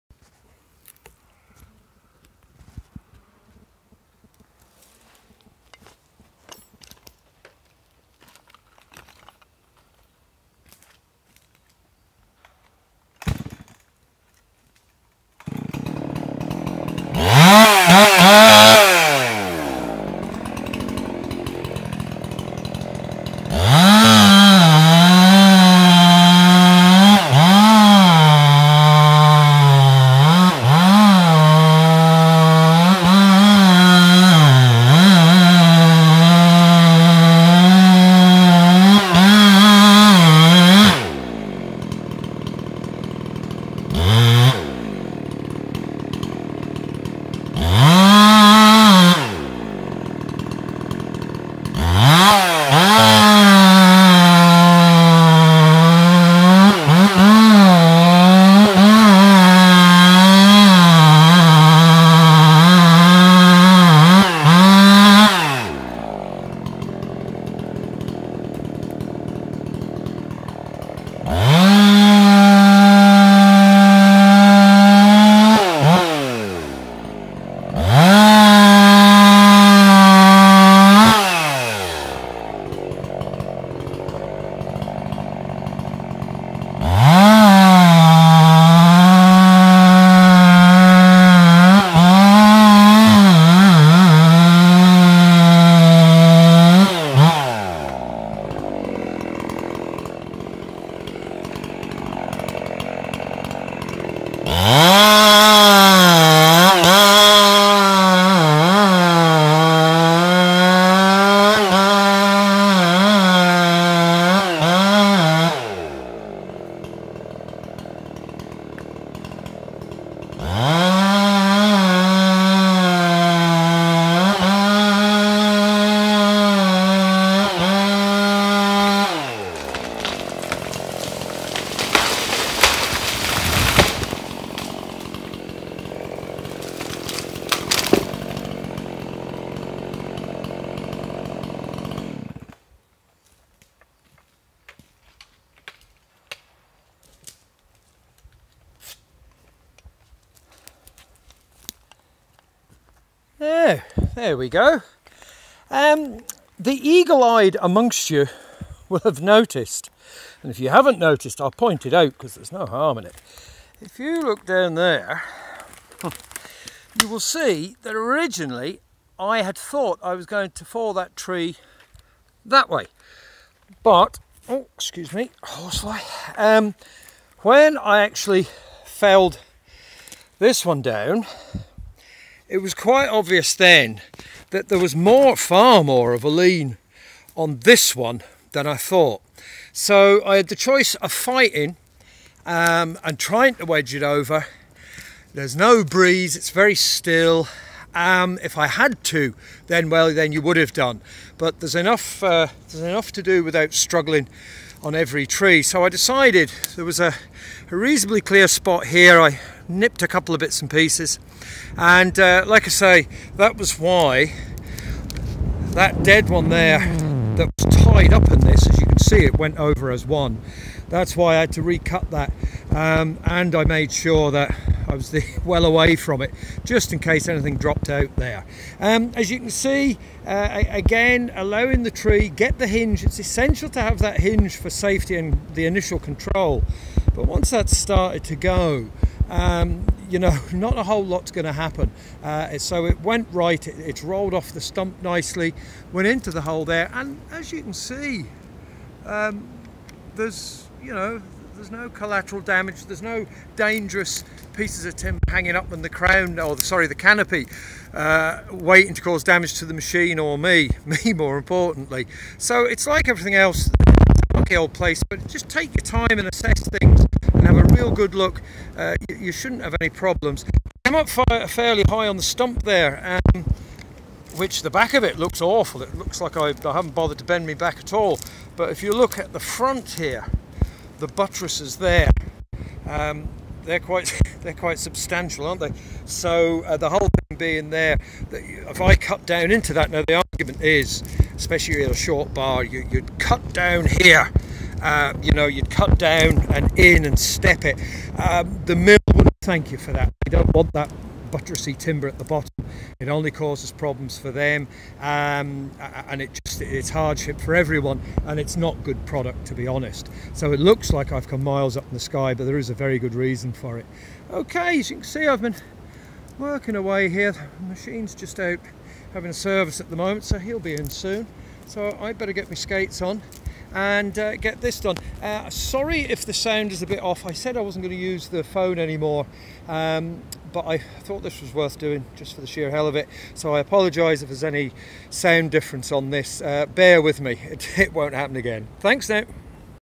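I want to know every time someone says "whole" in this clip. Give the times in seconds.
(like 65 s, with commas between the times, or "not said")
240 s, 286 s.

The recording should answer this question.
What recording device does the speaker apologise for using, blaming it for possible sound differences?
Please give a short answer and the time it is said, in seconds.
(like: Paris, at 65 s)
the phone, at 328 s.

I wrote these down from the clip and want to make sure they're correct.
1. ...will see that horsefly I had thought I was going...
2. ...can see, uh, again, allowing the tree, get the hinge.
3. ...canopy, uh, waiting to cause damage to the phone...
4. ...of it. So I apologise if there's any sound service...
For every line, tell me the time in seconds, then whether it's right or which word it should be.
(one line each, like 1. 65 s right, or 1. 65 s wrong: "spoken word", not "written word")
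1. 167 s wrong: "originally", not "horsefly"
2. 229 s right
3. 256 s wrong: "machine", not "phone"
4. 332 s wrong: "difference", not "service".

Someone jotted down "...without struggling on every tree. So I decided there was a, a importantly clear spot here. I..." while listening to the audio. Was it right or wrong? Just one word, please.
wrong.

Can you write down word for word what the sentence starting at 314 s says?
Okay, as you can see, I've been working away here.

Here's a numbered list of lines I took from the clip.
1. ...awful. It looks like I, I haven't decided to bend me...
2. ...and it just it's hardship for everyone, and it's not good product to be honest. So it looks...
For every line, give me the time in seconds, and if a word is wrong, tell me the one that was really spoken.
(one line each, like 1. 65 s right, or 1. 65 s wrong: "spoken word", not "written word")
1. 275 s wrong: "bothered", not "decided"
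2. 305 s right.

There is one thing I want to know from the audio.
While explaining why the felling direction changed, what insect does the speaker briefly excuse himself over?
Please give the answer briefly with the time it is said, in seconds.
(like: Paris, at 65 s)
horsefly, at 175 s.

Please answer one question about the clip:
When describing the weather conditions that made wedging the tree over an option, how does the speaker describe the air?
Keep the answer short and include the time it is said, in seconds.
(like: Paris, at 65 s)
no breeze, at 195 s.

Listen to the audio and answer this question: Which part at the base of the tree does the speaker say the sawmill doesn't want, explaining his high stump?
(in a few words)
buttresses.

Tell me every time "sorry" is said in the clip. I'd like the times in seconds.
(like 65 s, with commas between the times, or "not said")
256 s, 325 s.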